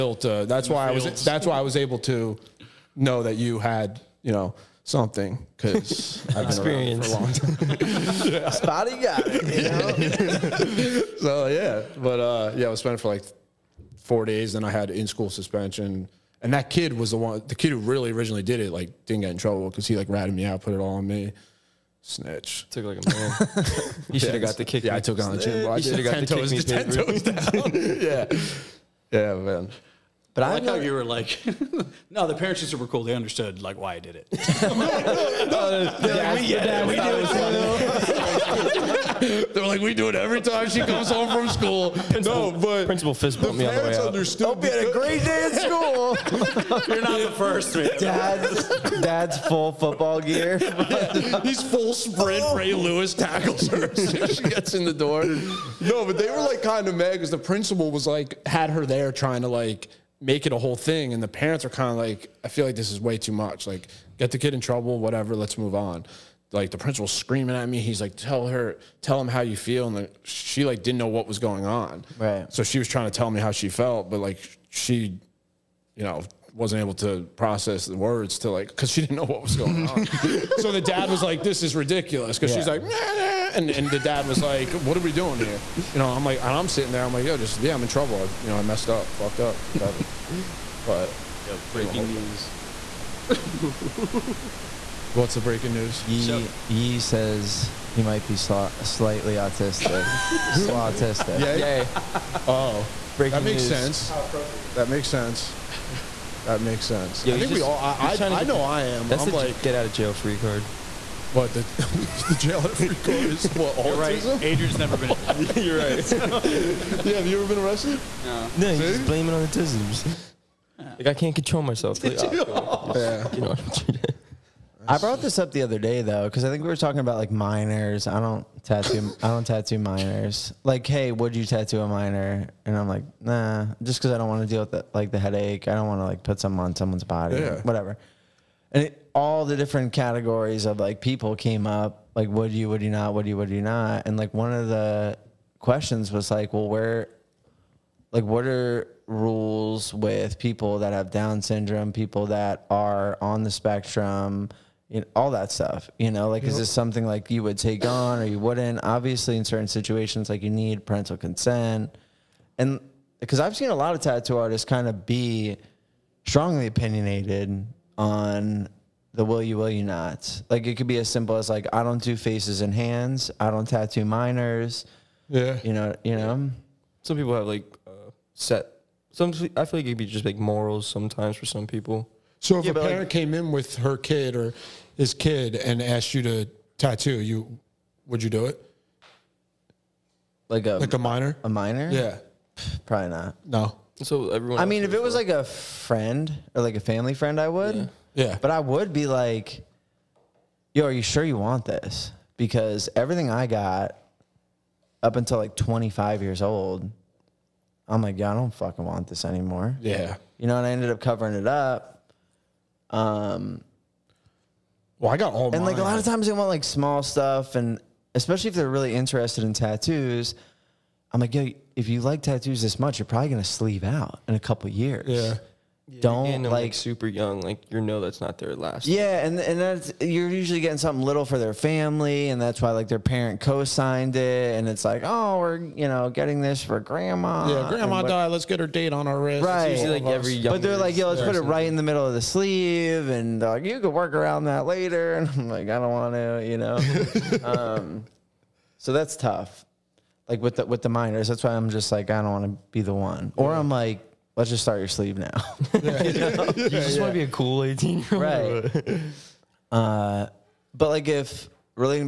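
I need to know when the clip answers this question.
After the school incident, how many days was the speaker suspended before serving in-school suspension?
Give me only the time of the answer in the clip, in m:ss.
0:13.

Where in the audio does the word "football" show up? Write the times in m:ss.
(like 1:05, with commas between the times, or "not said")
0:49.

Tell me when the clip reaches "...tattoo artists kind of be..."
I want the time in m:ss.
2:44.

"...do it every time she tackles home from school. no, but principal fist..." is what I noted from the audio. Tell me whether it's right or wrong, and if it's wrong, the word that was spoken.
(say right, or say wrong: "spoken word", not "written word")
wrong: "comes", not "tackles".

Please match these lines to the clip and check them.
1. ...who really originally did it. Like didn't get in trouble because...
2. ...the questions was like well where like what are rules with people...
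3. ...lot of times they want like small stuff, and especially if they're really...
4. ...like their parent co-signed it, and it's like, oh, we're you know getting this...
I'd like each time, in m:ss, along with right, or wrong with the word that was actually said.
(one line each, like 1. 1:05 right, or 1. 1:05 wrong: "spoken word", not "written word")
1. 0:17 right
2. 2:24 right
3. 3:35 right
4. 3:52 right.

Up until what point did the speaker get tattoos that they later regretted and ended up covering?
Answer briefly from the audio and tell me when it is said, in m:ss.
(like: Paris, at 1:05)
25 years old, at 3:25.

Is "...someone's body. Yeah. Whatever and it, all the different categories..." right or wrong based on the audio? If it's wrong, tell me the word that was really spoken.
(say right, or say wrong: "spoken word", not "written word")
right.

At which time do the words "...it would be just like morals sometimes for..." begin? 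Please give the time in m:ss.
2:59.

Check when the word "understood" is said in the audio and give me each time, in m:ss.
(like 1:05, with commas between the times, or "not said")
0:33, 0:44.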